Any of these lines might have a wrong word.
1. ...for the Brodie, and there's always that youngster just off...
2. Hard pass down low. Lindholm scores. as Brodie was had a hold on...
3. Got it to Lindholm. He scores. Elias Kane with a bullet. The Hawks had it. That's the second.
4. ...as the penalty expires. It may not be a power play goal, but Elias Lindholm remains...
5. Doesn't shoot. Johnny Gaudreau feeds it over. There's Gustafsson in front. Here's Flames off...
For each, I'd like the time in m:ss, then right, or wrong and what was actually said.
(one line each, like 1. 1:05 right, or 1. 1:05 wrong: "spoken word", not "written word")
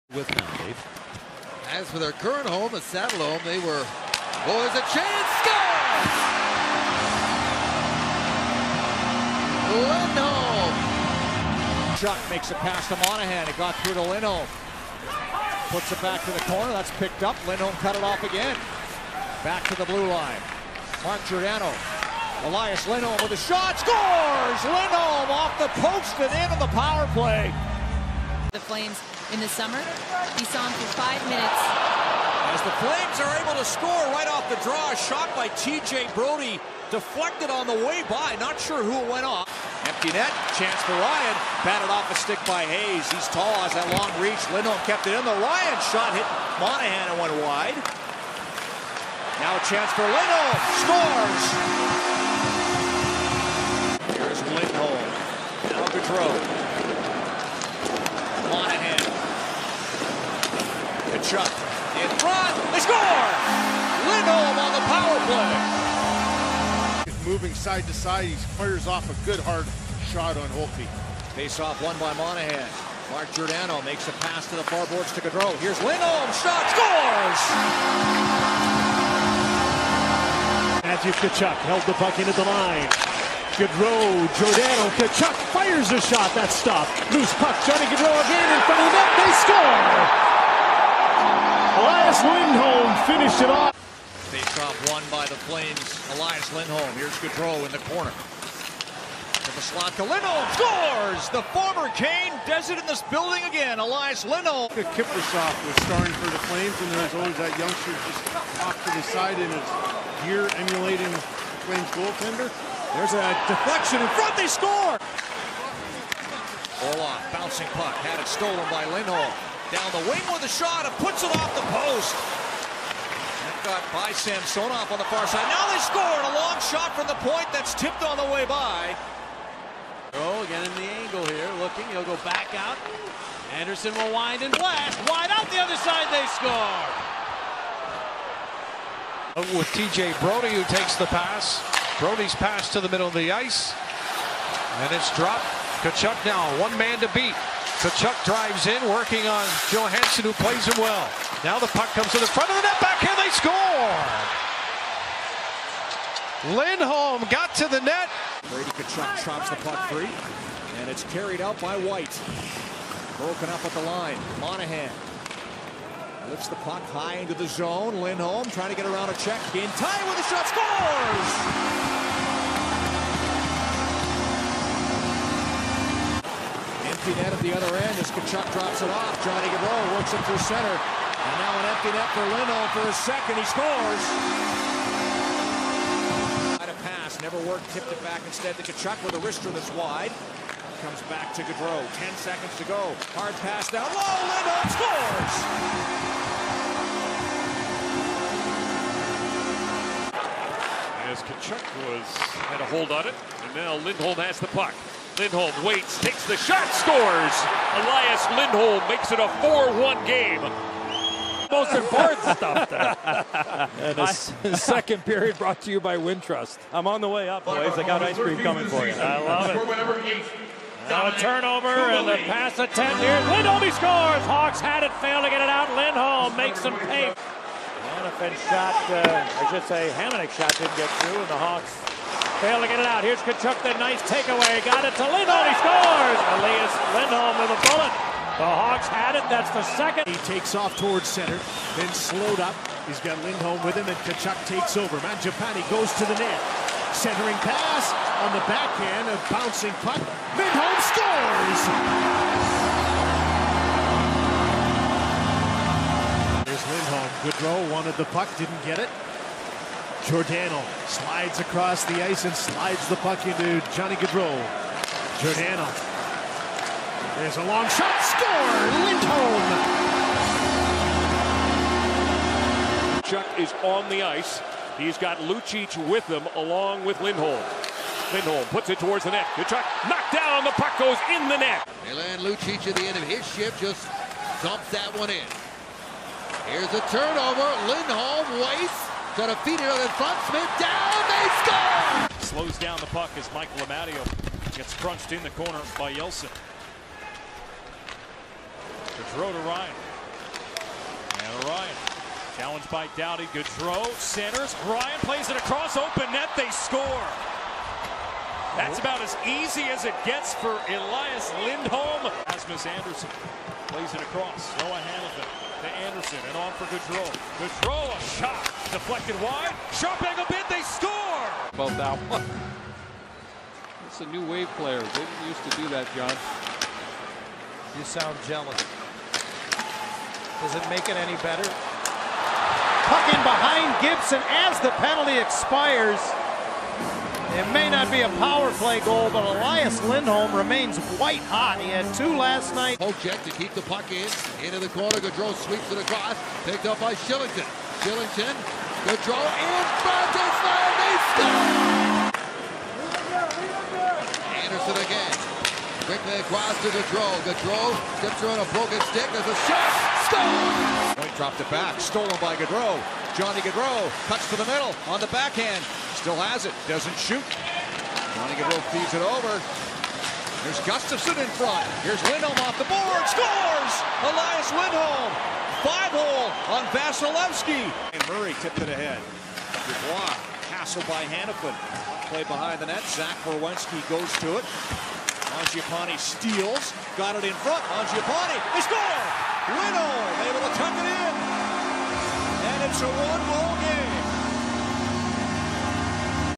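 1. 1:46 wrong: "Flames", not "Brodie"
2. 3:13 wrong: "Tkachuk", not "Brodie"
3. 3:54 wrong: "Lindholm", not "Kane"
4. 5:34 right
5. 6:06 wrong: "Lindholm", not "Flames".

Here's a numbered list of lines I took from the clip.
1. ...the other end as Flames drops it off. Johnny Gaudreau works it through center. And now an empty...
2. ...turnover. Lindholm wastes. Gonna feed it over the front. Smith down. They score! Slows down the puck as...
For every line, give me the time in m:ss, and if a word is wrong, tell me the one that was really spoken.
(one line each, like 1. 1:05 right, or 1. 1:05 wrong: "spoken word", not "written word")
1. 2:57 wrong: "Tkachuk", not "Flames"
2. 4:46 right.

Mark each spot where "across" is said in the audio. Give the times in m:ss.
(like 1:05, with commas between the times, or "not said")
4:21, 5:05, 5:14, 5:45, 5:56.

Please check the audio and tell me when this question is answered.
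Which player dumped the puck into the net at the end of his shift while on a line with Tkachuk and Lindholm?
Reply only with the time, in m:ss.
4:41.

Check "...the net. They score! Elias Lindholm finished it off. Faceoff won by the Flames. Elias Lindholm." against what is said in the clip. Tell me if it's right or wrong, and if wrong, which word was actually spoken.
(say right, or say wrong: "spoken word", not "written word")
right.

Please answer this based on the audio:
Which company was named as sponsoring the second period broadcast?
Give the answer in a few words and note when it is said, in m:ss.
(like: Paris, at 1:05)
Wintrust, at 3:35.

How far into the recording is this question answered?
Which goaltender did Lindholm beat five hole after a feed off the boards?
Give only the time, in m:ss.
6:16.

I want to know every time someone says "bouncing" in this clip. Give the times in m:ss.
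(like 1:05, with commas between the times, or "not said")
1:57, 4:09.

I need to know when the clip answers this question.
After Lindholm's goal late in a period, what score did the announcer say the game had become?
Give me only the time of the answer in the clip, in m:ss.
3:29.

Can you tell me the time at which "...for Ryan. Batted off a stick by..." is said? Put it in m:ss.
0:40.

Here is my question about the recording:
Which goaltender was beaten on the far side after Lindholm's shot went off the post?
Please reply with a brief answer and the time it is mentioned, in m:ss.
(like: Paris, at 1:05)
Samsonov, at 2:04.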